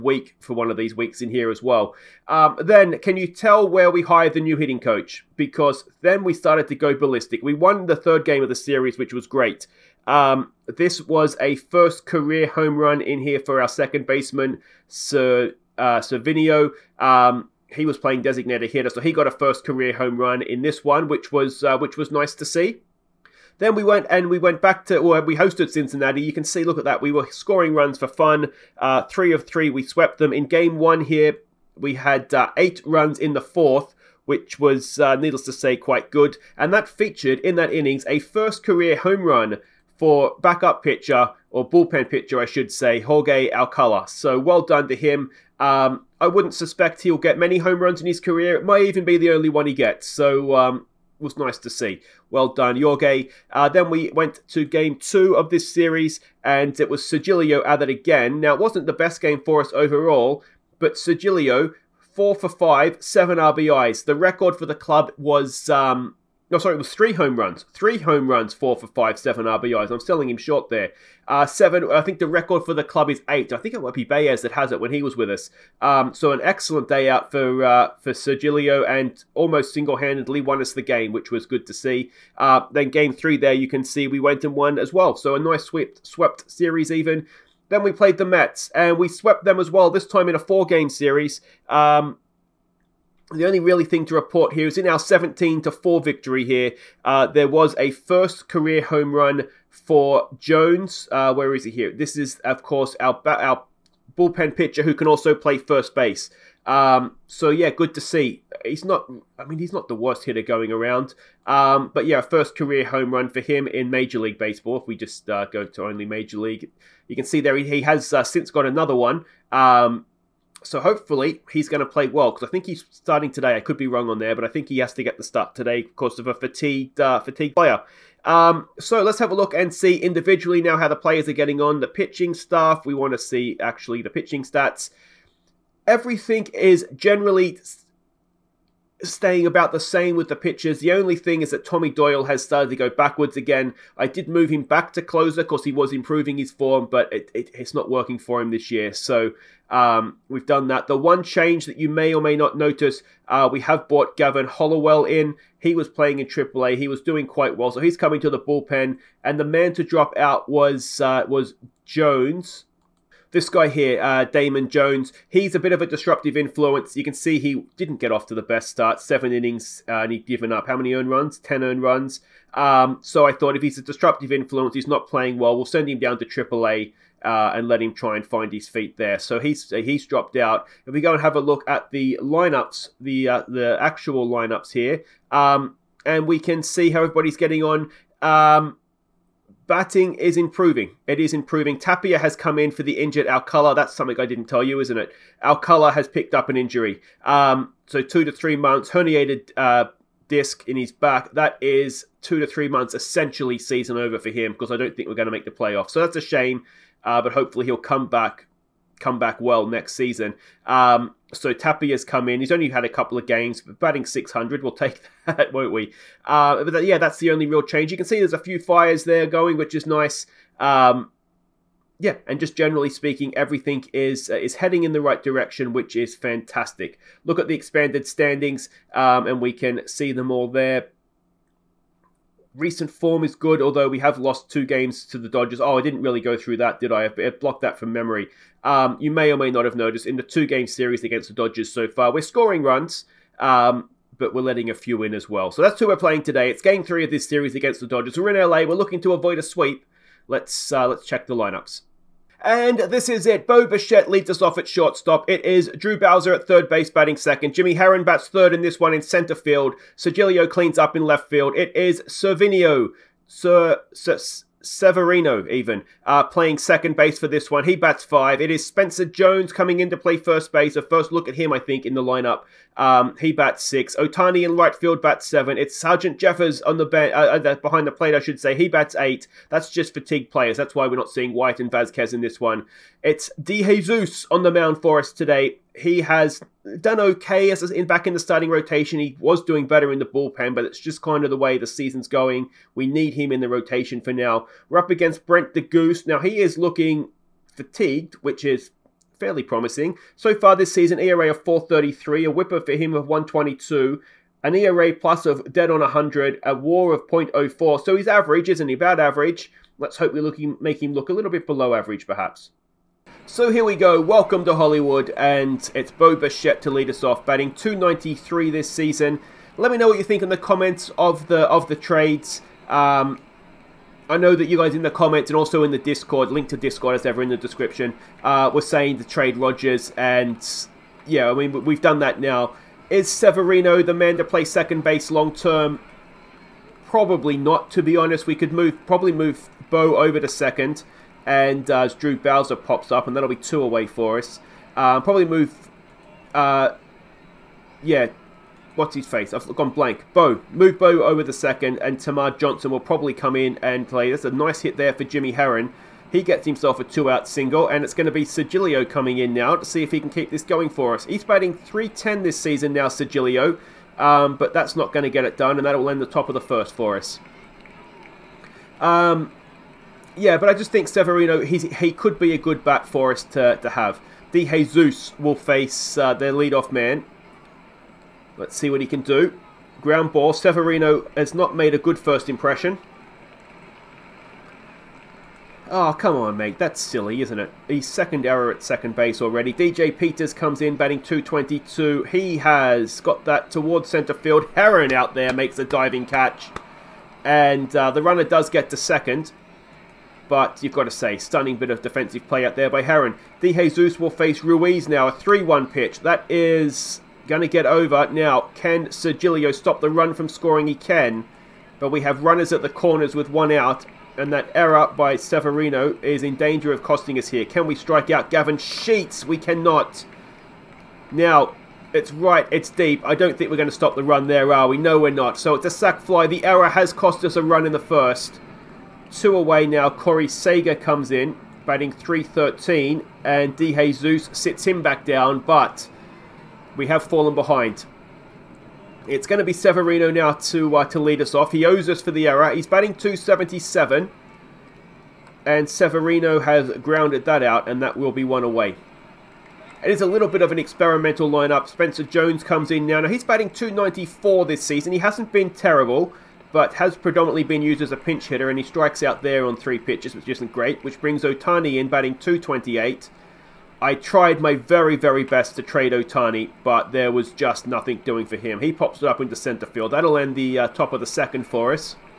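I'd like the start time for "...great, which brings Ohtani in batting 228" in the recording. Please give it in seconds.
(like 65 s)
460 s.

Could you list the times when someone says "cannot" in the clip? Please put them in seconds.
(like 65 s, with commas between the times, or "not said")
419 s.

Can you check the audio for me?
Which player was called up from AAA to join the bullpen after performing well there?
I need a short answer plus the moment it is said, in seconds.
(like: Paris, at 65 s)
Gavin Hollowell, at 154 s.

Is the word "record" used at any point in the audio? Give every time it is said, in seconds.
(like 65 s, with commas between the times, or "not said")
64 s, 72 s.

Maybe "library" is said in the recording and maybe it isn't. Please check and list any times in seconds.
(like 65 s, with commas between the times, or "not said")
not said.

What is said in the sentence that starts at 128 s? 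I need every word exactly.
Um, so let's have a look and see individually now how the players are getting on.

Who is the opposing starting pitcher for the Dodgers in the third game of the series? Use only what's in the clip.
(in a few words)
Brett de Geus.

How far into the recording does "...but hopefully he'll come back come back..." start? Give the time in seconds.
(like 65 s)
207 s.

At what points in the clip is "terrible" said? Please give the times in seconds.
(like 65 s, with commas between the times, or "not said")
455 s.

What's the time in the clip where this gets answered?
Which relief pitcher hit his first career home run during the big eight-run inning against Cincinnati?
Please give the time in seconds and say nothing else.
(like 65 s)
43 s.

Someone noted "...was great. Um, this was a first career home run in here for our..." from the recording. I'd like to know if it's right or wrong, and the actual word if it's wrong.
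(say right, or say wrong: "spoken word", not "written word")
right.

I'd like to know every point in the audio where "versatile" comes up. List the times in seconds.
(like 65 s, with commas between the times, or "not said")
not said.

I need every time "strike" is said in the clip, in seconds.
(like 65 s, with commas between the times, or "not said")
417 s, 458 s.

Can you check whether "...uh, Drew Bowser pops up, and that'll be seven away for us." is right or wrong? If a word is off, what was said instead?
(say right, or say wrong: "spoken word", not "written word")
wrong: "two", not "seven".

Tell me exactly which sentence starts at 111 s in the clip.
Um, but yeah, first career home run for him in Major League Baseball.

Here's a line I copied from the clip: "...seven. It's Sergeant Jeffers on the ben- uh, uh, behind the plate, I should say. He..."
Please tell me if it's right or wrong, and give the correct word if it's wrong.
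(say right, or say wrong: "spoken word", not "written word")
right.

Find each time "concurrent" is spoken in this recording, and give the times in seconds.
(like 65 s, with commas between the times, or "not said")
not said.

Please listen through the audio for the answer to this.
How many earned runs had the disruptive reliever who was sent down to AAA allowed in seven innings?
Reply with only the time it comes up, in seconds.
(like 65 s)
171 s.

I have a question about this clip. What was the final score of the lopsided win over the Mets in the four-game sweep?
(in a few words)
17 to 4.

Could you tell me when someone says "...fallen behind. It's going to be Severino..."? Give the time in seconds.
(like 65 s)
437 s.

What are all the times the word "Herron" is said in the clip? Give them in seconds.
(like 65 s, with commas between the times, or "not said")
257 s, 355 s, 394 s, 402 s.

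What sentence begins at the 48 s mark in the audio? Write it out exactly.
It might even be the only one he gets.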